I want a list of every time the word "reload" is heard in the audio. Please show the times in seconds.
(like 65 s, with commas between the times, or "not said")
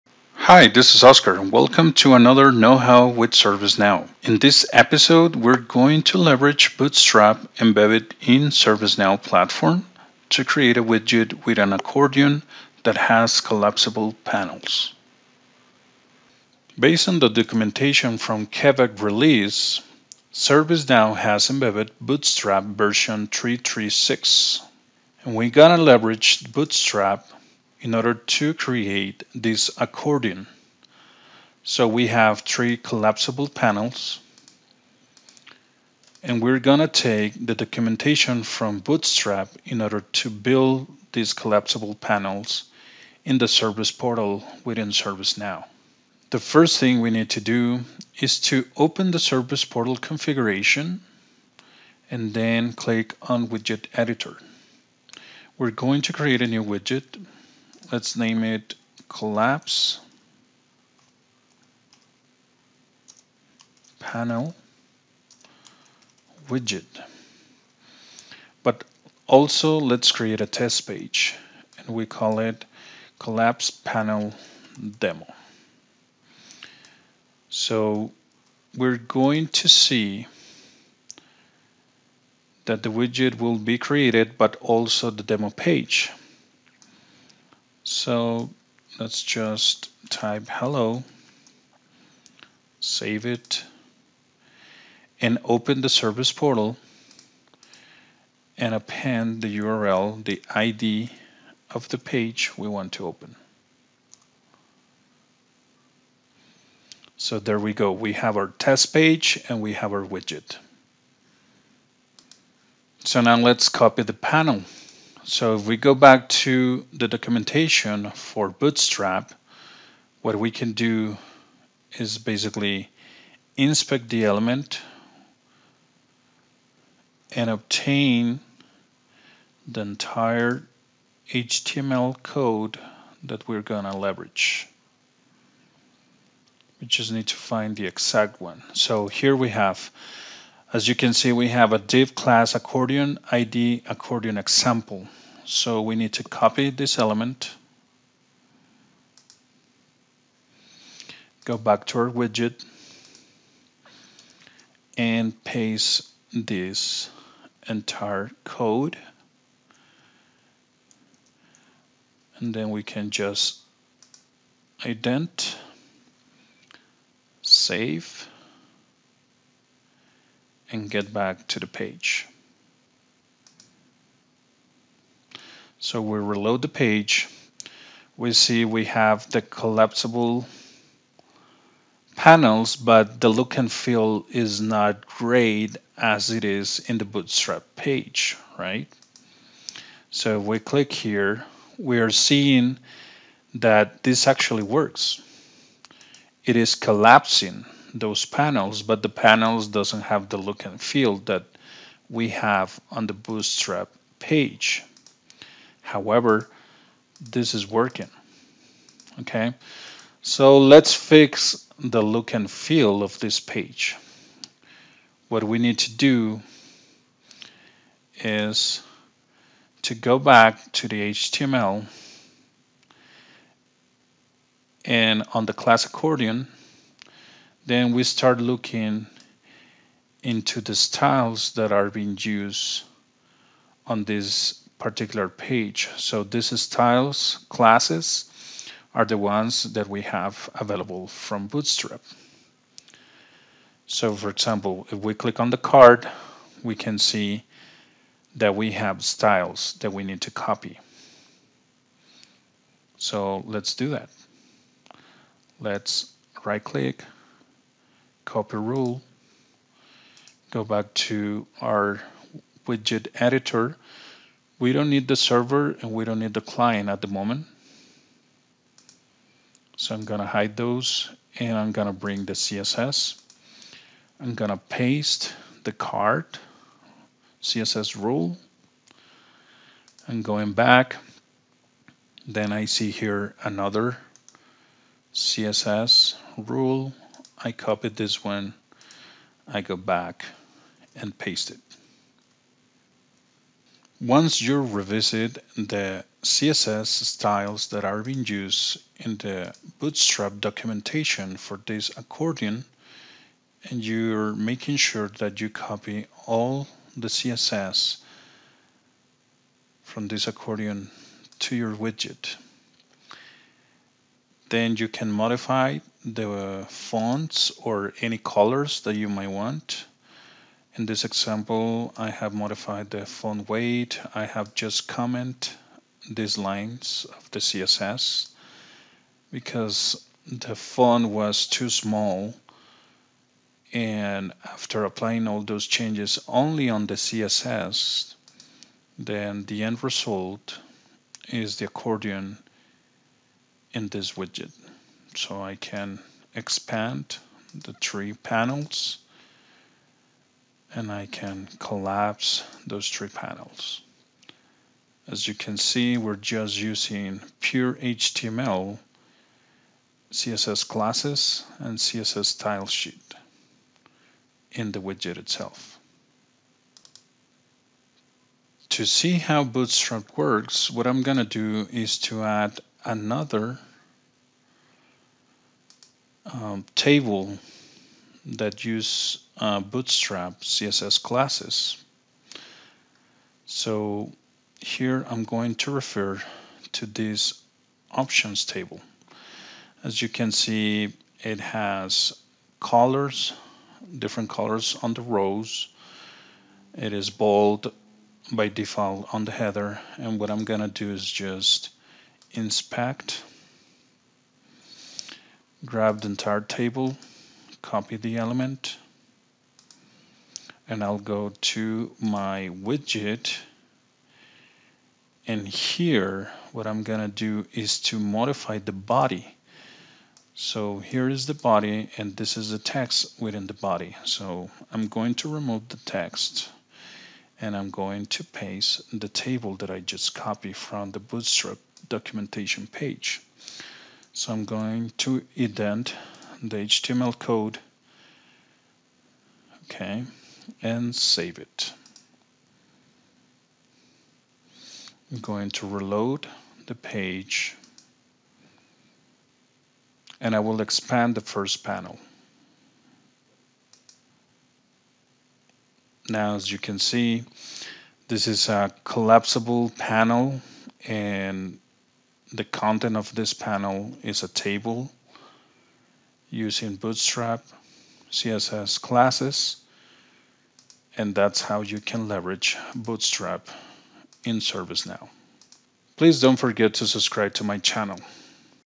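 176 s, 445 s.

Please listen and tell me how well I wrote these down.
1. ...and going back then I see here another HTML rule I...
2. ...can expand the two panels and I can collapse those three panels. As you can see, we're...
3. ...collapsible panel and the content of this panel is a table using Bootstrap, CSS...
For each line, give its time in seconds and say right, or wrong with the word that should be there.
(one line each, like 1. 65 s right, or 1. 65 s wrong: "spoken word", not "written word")
1. 280 s wrong: "CSS", not "HTML"
2. 345 s wrong: "three", not "two"
3. 458 s right.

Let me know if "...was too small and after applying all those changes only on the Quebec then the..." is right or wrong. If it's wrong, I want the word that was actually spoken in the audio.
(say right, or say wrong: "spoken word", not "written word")
wrong: "CSS", not "Quebec".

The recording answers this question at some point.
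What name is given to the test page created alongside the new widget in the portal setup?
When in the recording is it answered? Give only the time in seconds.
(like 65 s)
73 s.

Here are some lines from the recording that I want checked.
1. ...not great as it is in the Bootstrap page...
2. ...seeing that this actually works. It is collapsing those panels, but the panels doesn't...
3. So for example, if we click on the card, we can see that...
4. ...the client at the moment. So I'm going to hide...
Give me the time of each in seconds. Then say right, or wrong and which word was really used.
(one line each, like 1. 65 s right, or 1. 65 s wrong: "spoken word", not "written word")
1. 184 s right
2. 192 s right
3. 243 s right
4. 266 s right.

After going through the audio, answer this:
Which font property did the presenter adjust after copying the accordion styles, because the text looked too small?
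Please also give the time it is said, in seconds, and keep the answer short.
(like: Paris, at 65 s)
font weight, at 323 s.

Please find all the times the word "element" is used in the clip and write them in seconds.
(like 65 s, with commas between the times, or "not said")
124 s, 146 s, 408 s.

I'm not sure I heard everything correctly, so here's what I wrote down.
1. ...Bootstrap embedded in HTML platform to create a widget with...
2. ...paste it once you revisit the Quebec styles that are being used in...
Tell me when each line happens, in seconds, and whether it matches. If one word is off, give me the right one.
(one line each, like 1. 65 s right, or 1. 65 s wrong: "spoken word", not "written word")
1. 6 s wrong: "ServiceNow", not "HTML"
2. 291 s wrong: "CSS", not "Quebec".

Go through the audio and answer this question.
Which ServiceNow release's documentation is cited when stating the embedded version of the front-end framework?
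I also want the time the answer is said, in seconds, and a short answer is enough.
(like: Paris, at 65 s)
Quebec, at 18 s.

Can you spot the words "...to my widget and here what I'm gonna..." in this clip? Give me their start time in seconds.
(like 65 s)
411 s.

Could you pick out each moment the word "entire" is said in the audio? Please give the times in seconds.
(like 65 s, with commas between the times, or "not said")
129 s, 157 s, 406 s.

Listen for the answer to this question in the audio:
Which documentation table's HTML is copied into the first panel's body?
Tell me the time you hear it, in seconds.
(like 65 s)
387 s.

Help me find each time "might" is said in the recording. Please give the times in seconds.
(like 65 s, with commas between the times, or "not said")
319 s.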